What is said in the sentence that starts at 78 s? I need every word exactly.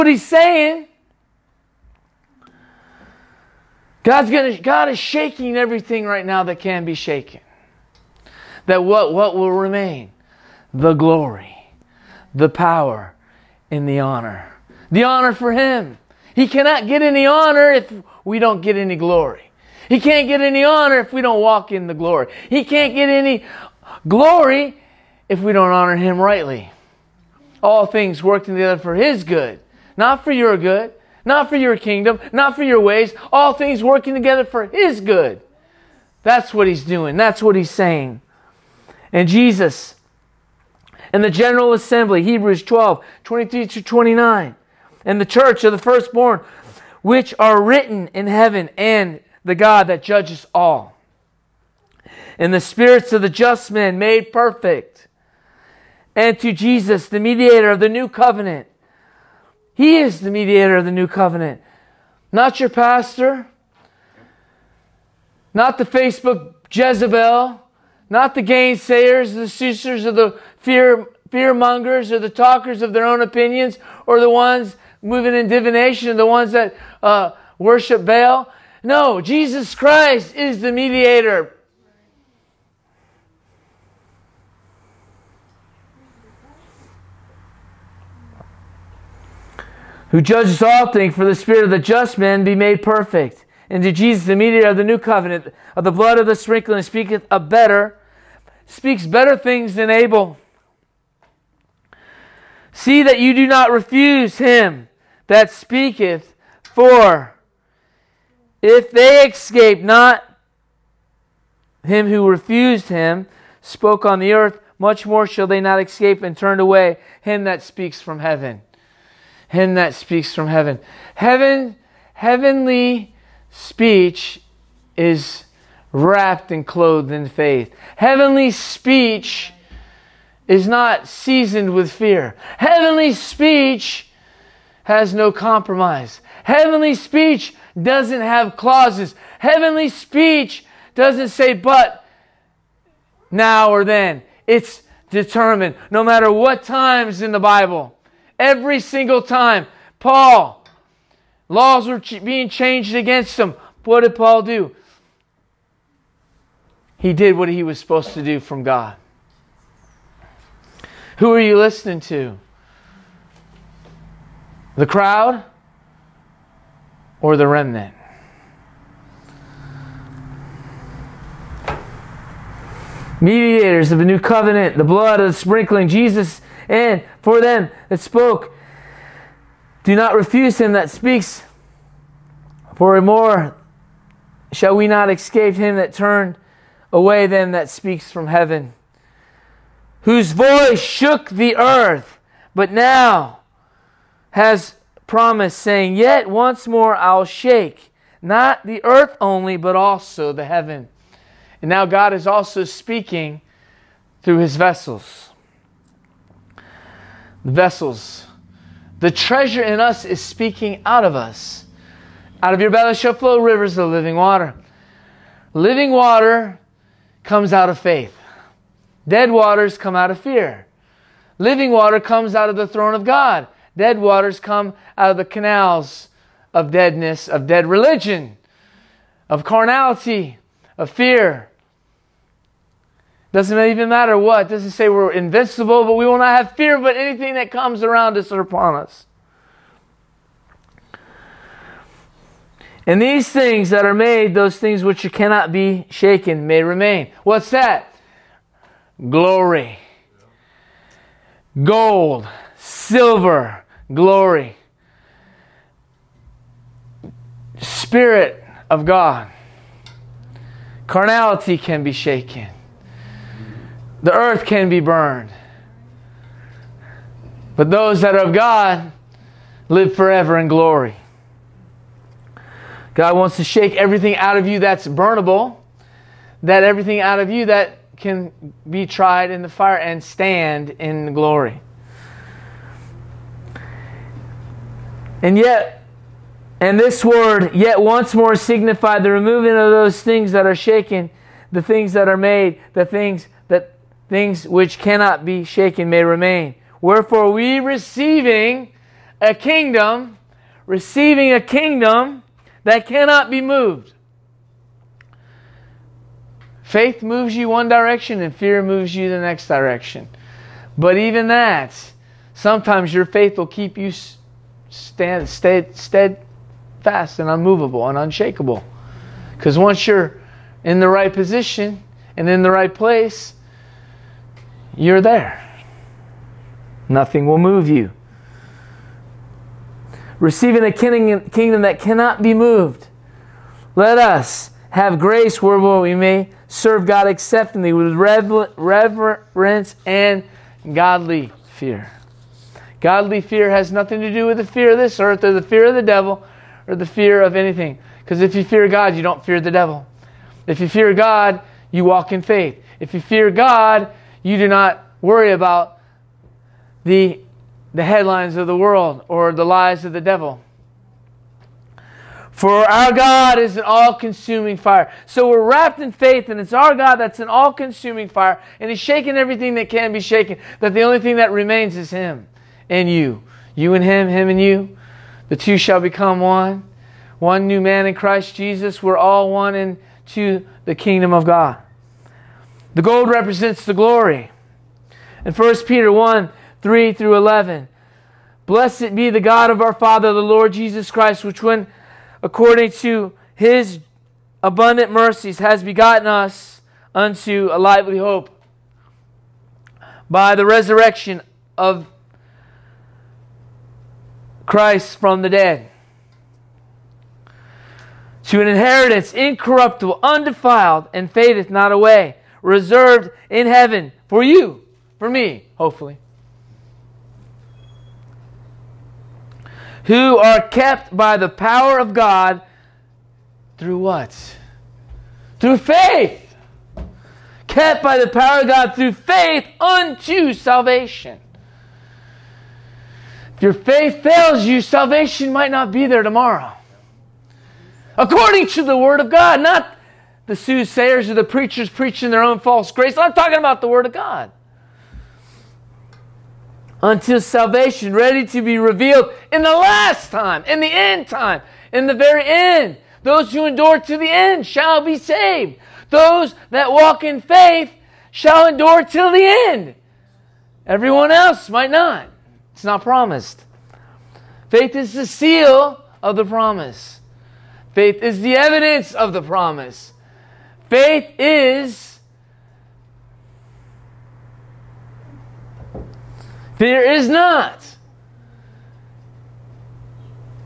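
No, Jesus Christ is the mediator.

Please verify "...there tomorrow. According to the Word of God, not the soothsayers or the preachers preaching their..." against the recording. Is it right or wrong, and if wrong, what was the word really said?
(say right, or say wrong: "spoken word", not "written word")
right.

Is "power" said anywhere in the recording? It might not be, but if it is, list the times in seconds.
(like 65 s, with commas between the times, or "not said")
12 s, 421 s, 428 s.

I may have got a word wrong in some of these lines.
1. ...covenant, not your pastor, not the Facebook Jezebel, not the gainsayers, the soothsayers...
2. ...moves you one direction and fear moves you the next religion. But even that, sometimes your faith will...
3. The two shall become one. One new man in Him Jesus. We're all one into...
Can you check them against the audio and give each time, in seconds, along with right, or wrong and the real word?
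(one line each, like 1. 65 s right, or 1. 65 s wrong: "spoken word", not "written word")
1. 61 s wrong: "seekers", not "soothsayers"
2. 307 s wrong: "direction", not "religion"
3. 375 s wrong: "Christ", not "Him".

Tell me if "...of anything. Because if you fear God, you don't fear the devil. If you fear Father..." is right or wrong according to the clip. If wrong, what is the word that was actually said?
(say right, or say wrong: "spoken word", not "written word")
wrong: "God", not "Father".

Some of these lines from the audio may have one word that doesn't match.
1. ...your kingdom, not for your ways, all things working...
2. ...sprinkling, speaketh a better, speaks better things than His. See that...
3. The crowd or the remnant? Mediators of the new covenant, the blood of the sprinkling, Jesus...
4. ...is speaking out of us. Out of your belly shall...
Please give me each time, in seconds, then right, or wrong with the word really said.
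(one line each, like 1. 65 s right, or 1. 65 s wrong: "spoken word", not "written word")
1. 31 s right
2. 96 s wrong: "Abel", not "His"
3. 164 s right
4. 210 s right.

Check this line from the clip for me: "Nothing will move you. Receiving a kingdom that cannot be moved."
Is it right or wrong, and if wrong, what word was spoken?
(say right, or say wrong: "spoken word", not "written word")
right.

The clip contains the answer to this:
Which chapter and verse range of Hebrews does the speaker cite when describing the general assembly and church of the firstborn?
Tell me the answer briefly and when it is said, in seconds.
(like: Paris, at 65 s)
Hebrews 12:23-29, at 42 s.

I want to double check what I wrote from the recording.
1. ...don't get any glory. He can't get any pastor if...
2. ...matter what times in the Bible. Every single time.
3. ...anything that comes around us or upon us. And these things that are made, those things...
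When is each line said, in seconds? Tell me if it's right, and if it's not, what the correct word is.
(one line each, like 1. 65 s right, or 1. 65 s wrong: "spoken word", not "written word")
1. 18 s wrong: "honor", not "pastor"
2. 146 s right
3. 236 s right.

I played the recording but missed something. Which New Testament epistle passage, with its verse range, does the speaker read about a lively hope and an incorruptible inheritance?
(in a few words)
1 Peter 1:3-11.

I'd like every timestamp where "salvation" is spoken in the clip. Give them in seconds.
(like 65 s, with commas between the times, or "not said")
430 s, 434 s, 447 s.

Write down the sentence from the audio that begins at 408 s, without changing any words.
To an inheritance incorruptible, undefiled, and fadeth not away reserved in heaven for you, for me, hopefully.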